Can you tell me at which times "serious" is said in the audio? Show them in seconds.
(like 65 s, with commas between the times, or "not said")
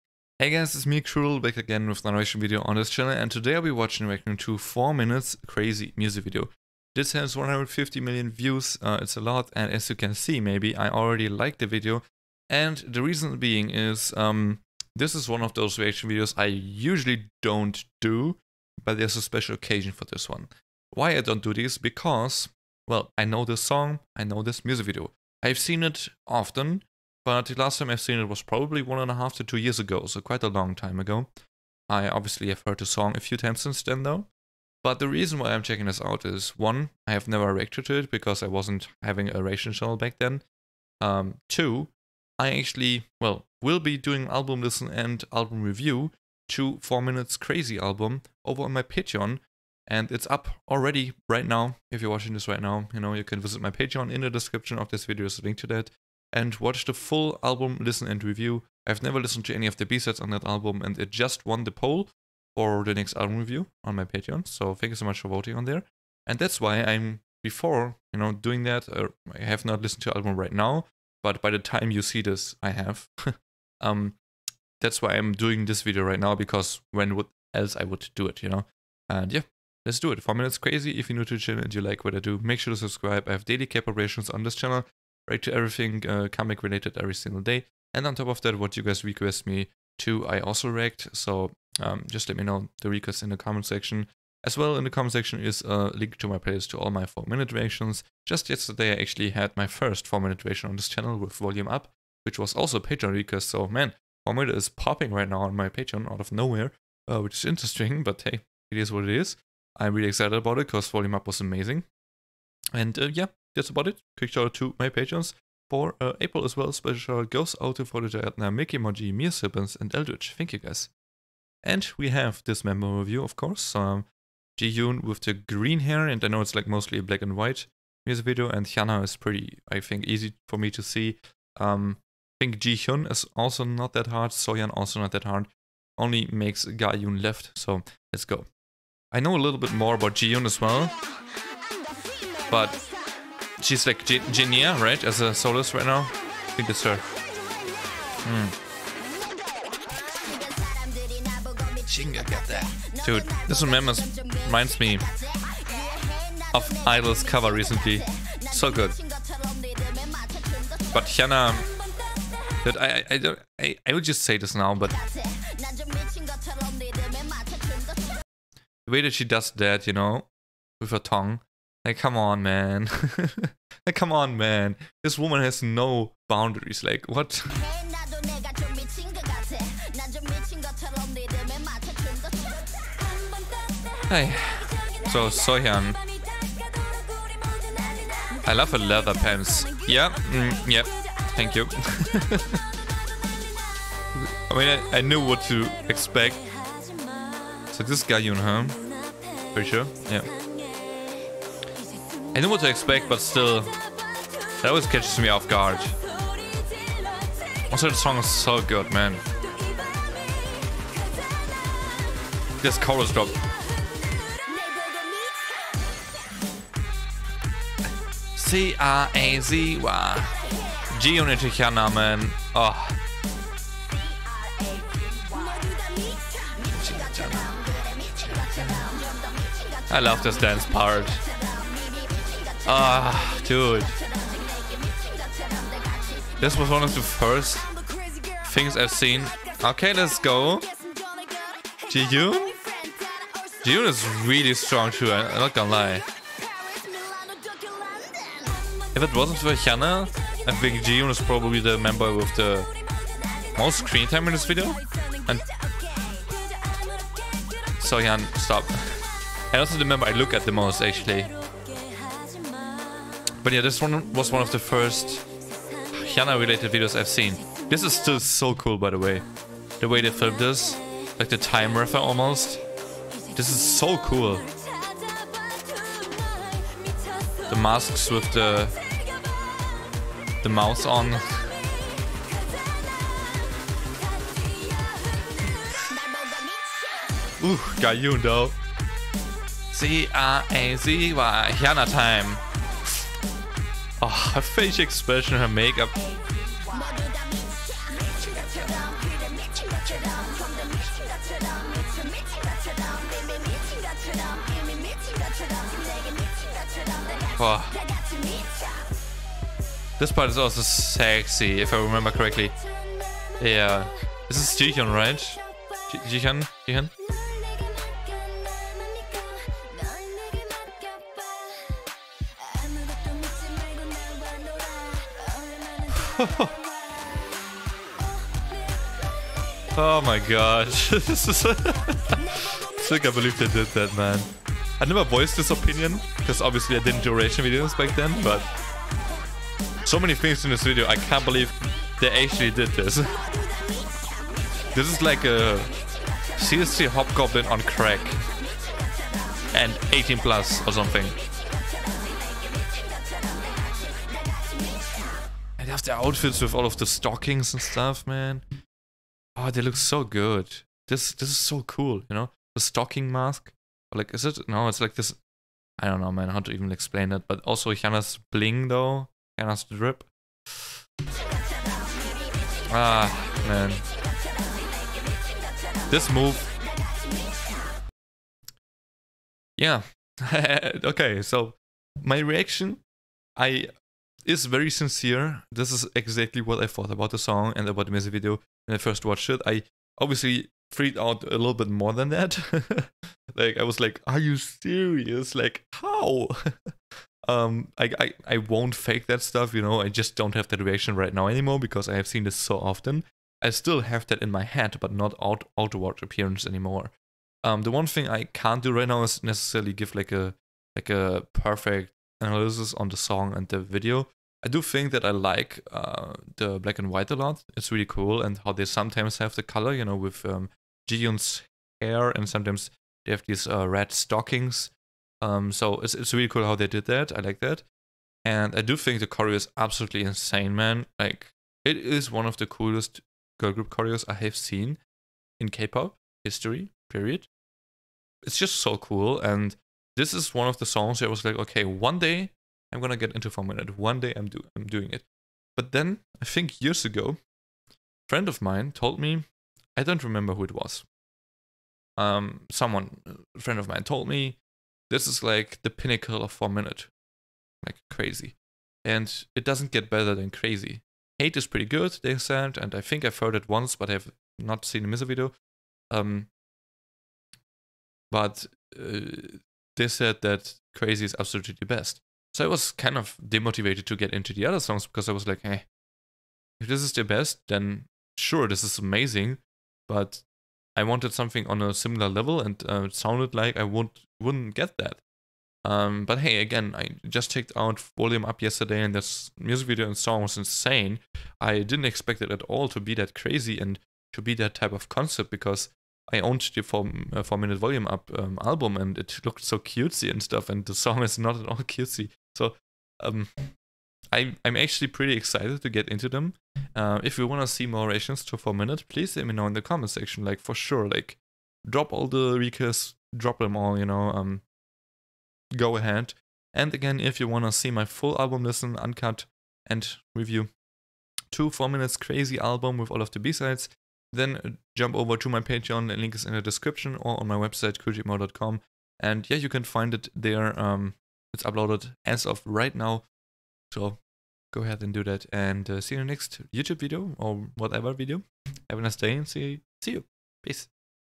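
394 s.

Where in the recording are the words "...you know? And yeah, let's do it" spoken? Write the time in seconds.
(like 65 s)
78 s.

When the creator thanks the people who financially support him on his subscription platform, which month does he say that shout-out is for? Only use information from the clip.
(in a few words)
April.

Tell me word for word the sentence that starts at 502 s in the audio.
So um, I, I'm actually pretty excited to get into them.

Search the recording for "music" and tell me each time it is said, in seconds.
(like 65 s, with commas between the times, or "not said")
5 s, 24 s, 128 s, 387 s, 464 s, 489 s.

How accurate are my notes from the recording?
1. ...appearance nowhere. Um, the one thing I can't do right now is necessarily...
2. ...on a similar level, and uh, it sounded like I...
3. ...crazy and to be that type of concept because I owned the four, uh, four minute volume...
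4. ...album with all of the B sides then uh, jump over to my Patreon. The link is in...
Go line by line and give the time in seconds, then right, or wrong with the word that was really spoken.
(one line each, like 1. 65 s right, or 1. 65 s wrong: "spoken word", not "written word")
1. 406 s wrong: "anymore", not "nowhere"
2. 481 s right
3. 493 s right
4. 522 s right.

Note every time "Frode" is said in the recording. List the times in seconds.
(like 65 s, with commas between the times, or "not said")
117 s.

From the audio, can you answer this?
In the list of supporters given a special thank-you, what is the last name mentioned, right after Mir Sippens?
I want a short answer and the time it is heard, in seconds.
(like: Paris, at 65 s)
Eldritch, at 119 s.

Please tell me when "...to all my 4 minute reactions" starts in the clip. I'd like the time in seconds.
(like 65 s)
96 s.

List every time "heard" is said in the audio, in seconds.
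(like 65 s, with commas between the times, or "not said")
32 s, 463 s.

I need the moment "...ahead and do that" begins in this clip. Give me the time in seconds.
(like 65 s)
534 s.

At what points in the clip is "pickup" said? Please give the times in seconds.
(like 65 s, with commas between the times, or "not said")
not said.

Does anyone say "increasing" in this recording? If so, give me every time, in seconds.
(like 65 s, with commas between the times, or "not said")
not said.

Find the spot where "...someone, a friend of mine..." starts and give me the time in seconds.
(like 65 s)
452 s.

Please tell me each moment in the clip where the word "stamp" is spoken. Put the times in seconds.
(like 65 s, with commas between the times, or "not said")
not said.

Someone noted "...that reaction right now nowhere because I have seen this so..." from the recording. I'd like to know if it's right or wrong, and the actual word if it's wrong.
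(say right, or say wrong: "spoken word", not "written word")
wrong: "anymore", not "nowhere".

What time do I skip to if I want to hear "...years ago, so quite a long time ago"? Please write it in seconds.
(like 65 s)
29 s.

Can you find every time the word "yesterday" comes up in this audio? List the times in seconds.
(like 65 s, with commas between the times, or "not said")
98 s, 488 s.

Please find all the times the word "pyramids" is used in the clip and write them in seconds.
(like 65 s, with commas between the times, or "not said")
not said.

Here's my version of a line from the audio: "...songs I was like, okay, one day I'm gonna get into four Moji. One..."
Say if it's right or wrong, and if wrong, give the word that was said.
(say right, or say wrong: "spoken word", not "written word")
wrong: "Minute", not "Moji".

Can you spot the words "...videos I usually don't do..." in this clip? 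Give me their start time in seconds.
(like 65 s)
16 s.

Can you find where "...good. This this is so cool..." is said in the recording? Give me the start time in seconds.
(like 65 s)
360 s.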